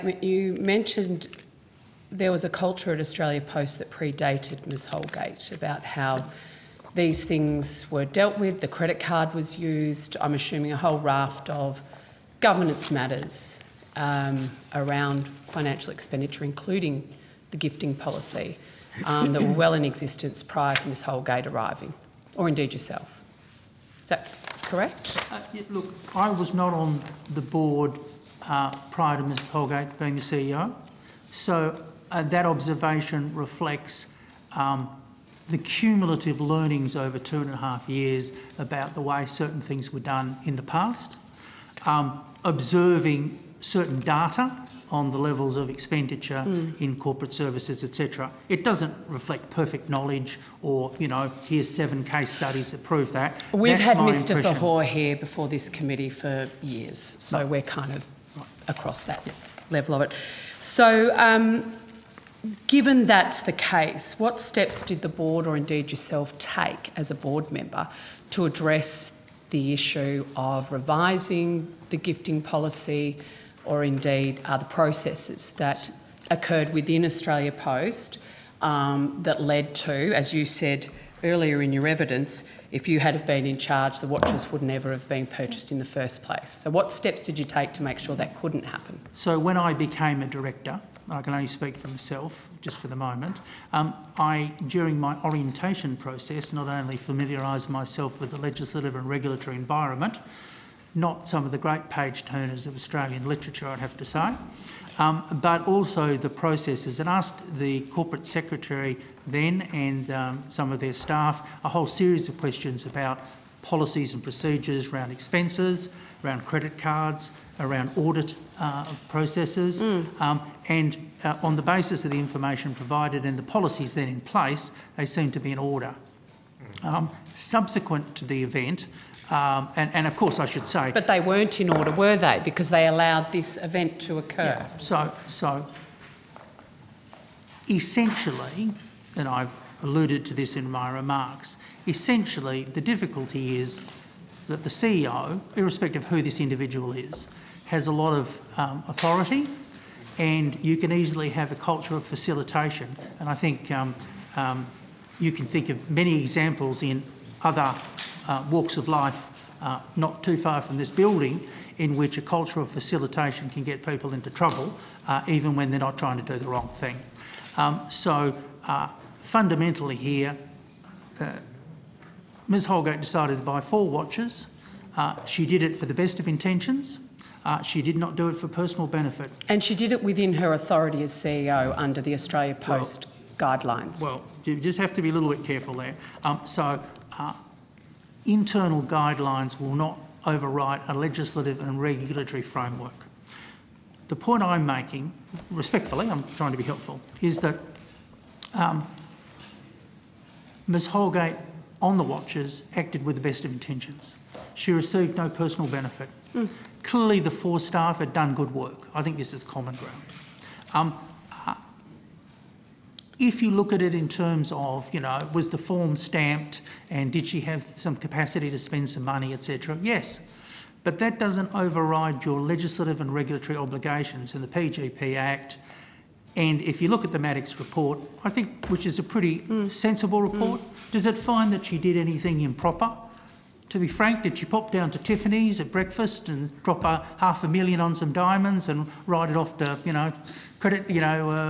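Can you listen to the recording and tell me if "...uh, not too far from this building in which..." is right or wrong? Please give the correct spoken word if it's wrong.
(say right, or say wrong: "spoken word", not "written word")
right.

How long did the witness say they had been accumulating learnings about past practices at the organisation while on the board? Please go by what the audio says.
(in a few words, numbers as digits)
2 and a half years.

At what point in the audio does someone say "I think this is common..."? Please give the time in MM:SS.
03:28.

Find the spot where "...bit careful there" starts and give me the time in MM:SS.
03:05.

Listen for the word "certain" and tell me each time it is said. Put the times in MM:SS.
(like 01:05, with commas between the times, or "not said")
00:39, 00:43.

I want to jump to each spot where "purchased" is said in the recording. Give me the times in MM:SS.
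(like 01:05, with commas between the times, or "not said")
01:25.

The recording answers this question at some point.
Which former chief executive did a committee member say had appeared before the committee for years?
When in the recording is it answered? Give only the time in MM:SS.
00:53.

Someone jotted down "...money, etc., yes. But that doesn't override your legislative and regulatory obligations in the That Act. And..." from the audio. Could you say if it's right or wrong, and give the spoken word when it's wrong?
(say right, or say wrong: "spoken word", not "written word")
wrong: "PGPA", not "That".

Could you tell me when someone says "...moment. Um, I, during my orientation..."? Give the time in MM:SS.
01:32.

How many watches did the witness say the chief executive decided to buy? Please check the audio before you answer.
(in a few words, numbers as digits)
4.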